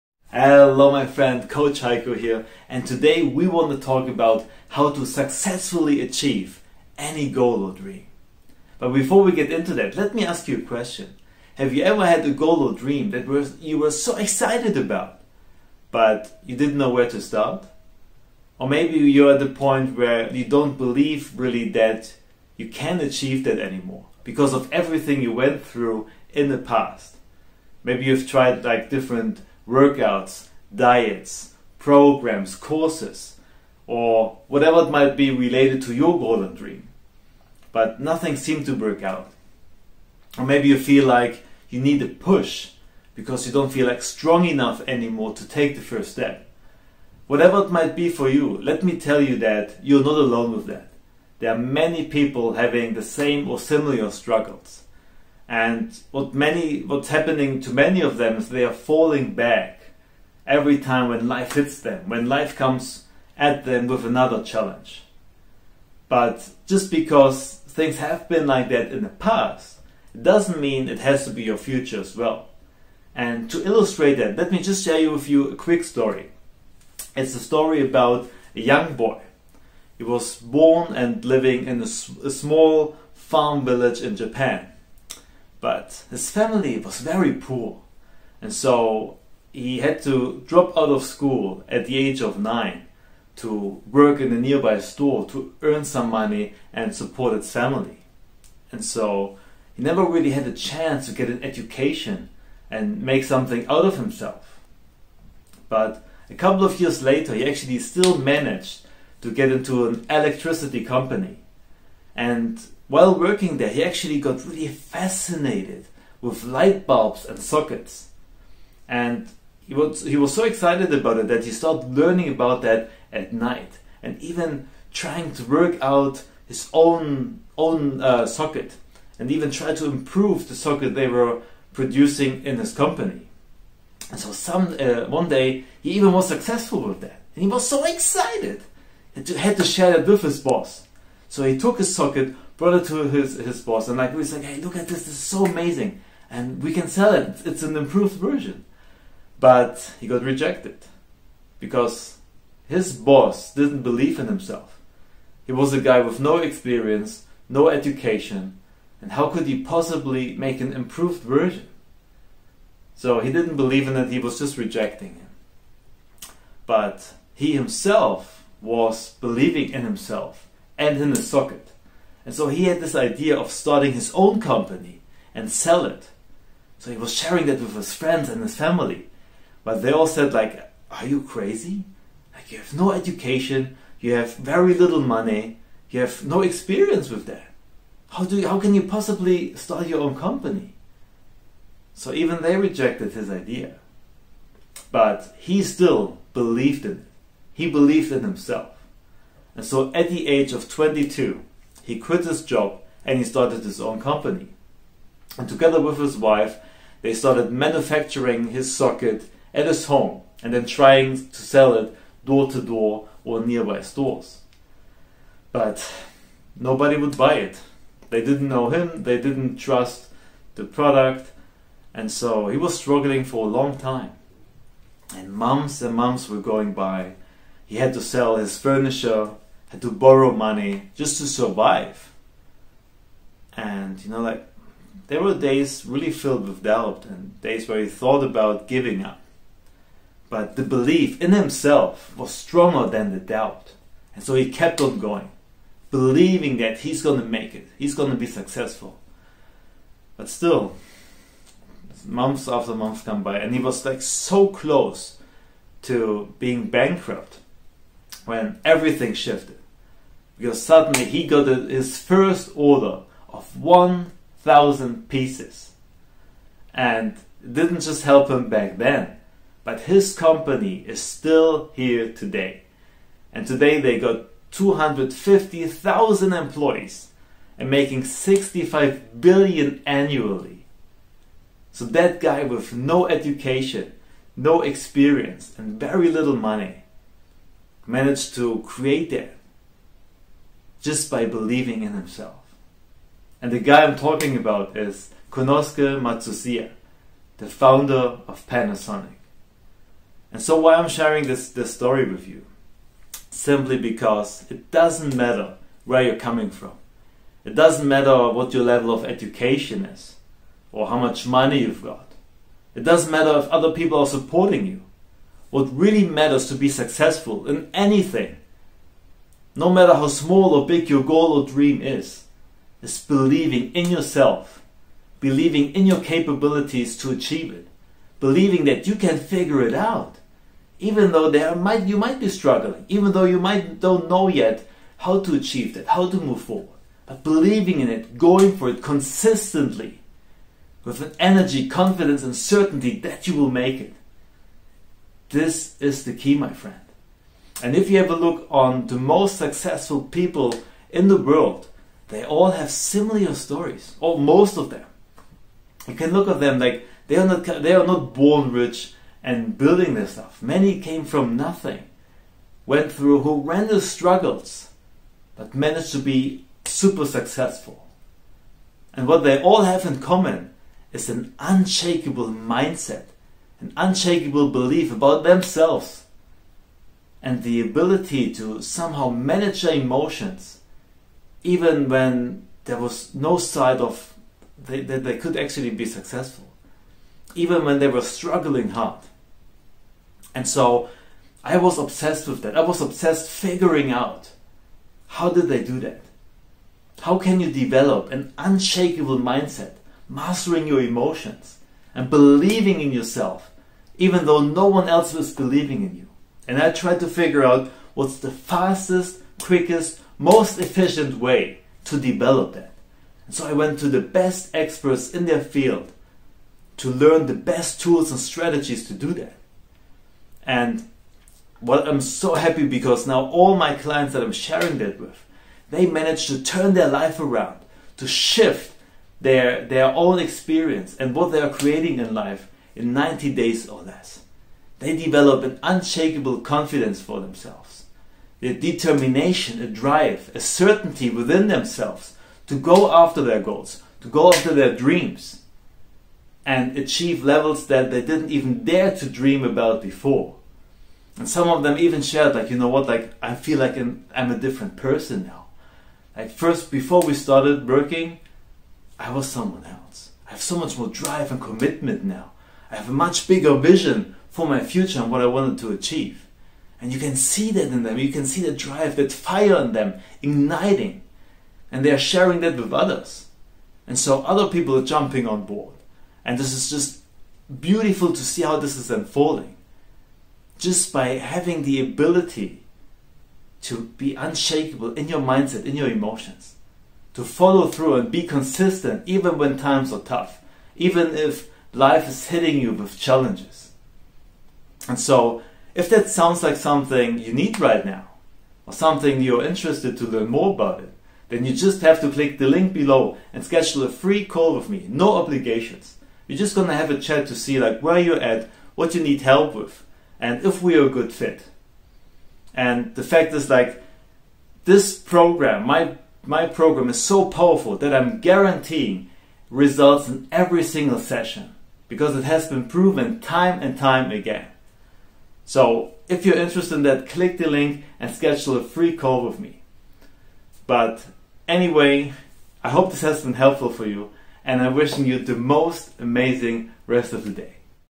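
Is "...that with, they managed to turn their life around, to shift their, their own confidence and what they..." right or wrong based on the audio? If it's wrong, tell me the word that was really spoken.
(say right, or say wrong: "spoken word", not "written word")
wrong: "experience", not "confidence".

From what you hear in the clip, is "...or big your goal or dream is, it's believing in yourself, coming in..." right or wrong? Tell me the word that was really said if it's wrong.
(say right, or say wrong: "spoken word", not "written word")
wrong: "believing", not "coming".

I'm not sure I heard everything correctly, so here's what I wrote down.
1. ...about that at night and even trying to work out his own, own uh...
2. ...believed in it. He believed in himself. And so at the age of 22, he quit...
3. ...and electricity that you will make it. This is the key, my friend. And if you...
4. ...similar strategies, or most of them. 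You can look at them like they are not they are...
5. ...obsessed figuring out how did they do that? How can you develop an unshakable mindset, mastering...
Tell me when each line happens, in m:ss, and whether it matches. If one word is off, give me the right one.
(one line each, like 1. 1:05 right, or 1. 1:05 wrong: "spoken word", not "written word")
1. 2:02 right
2. 3:16 right
3. 5:42 wrong: "certainty", not "electricity"
4. 5:52 wrong: "stories", not "strategies"
5. 6:32 right.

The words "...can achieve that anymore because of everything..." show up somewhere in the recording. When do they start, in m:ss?
0:22.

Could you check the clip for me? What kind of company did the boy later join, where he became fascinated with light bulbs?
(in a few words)
Electricity company.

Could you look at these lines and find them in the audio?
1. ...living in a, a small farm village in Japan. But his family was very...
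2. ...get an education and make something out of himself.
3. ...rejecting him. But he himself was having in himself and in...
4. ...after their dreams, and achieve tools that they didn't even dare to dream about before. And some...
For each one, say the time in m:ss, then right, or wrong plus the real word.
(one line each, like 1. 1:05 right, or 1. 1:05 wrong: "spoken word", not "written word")
1. 1:21 right
2. 1:41 right
3. 2:44 wrong: "believing", not "having"
4. 7:24 wrong: "levels", not "tools".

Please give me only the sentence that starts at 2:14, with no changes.
And so some, uh, one day he even was successful with that.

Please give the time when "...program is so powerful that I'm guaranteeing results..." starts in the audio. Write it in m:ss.
8:36.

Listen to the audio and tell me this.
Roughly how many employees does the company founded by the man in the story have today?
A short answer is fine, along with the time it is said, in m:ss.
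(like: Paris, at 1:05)
250,000, at 4:34.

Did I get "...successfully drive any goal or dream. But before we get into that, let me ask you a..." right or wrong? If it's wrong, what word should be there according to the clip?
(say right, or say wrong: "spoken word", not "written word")
wrong: "achieve", not "drive".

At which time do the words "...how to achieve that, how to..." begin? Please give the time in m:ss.
5:34.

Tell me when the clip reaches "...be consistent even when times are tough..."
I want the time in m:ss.
8:08.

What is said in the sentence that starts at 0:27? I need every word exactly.
Maybe you've tried like different workouts, diets, programs, courses, or whatever it might be related to your golden dream.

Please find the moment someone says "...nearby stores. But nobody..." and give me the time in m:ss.
3:33.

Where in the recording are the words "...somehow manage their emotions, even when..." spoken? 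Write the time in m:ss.
6:18.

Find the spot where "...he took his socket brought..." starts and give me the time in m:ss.
2:21.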